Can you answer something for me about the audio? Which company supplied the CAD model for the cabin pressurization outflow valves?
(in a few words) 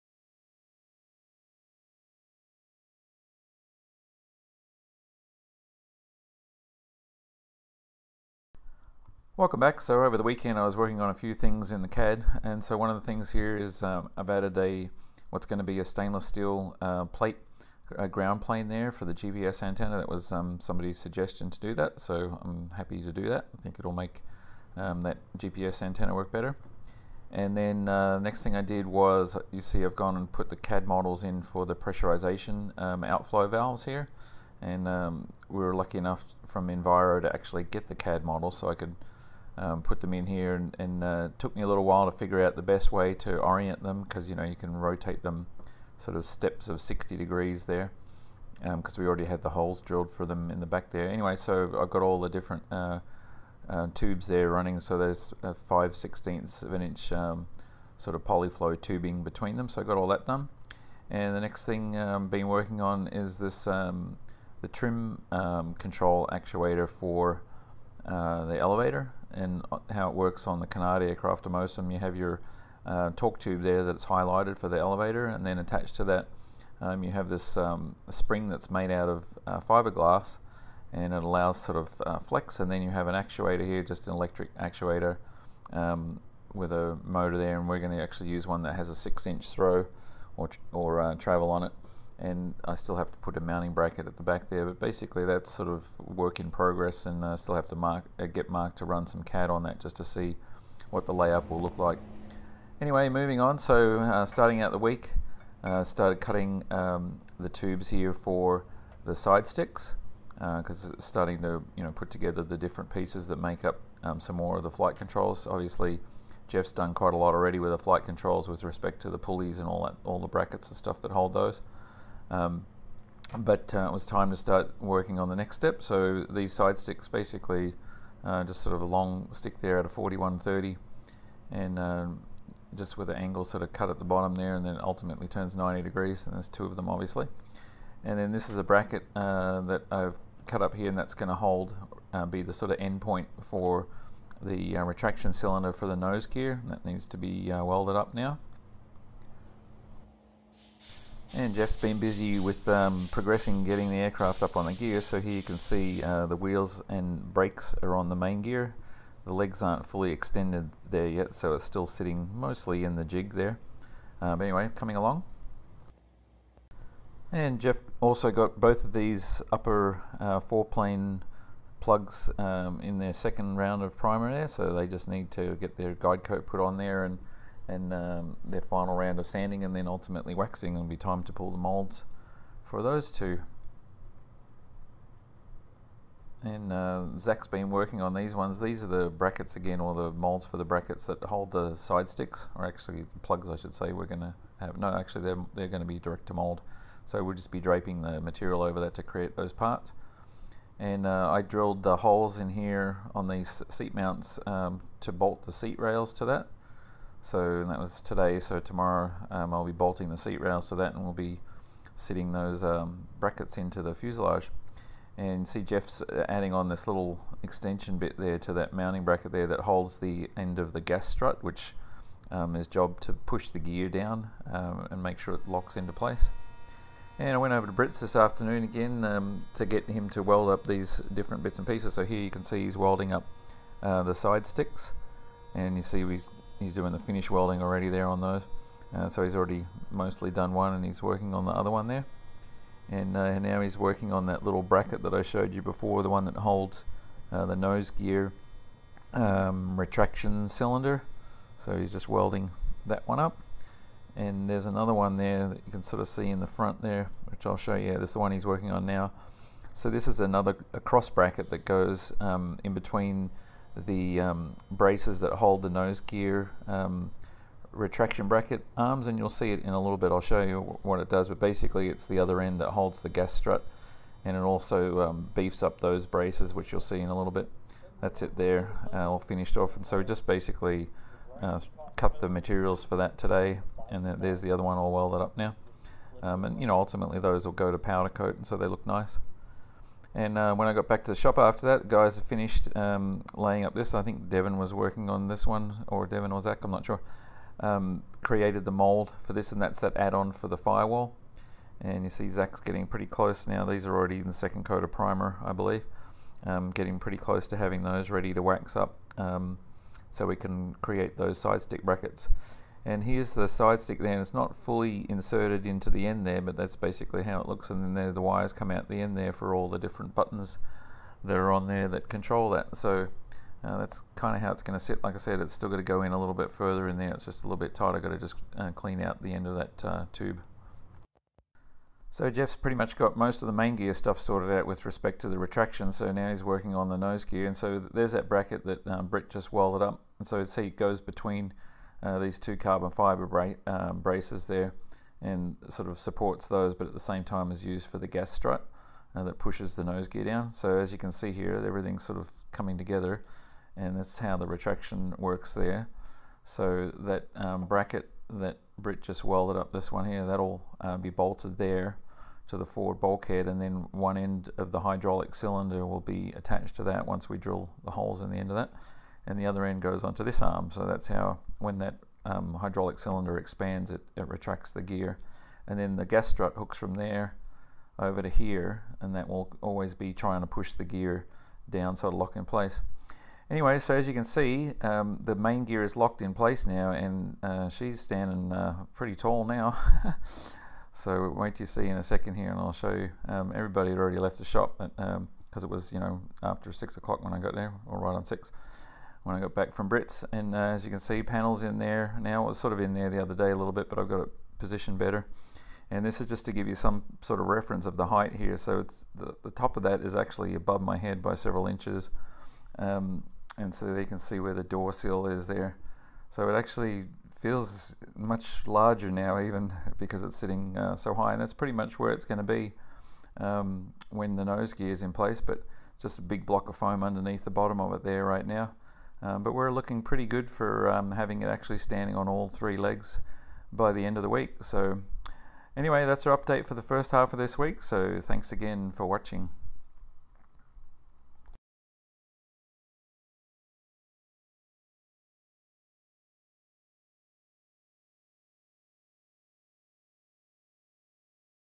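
Enviro.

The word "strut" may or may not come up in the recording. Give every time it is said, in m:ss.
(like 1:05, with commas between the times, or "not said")
3:41, 4:33, 5:48, 6:16.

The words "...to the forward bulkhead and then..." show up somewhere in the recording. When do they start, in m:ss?
6:02.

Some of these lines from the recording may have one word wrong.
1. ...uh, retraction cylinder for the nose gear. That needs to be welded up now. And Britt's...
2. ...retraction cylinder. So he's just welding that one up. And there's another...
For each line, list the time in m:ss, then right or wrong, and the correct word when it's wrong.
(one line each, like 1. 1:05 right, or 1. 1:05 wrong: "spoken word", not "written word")
1. 2:24 wrong: "Jeff", not "Britt"
2. 4:09 right.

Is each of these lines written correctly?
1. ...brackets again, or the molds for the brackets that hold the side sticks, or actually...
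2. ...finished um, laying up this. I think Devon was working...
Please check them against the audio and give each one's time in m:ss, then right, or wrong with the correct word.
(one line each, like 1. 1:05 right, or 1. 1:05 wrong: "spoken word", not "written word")
1. 3:09 right
2. 4:52 right.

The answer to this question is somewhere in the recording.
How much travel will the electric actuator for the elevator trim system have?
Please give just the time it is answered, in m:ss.
1:28.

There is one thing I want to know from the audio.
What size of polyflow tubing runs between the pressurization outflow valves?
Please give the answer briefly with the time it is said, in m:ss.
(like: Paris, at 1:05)
5/16 inch, at 0:55.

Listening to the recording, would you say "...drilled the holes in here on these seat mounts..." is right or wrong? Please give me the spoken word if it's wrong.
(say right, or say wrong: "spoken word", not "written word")
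right.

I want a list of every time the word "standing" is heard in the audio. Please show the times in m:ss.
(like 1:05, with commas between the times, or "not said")
6:27, 7:11.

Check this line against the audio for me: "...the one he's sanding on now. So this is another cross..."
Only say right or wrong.
wrong.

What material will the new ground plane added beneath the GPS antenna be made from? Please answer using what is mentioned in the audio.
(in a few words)
stainless steel.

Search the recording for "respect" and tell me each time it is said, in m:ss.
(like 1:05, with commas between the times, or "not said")
1:58, 5:34.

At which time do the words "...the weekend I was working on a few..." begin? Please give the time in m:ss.
0:10.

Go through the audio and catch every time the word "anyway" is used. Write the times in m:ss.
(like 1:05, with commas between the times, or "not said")
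0:51, 1:42, 2:44, 6:23, 7:15.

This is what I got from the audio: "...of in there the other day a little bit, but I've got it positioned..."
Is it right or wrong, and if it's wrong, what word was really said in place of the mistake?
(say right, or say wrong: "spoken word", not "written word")
right.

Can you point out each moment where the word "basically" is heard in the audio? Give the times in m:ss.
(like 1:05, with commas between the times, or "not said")
1:34, 2:07, 4:31, 4:40, 5:16.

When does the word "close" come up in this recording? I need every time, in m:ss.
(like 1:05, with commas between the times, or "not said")
5:03, 5:07.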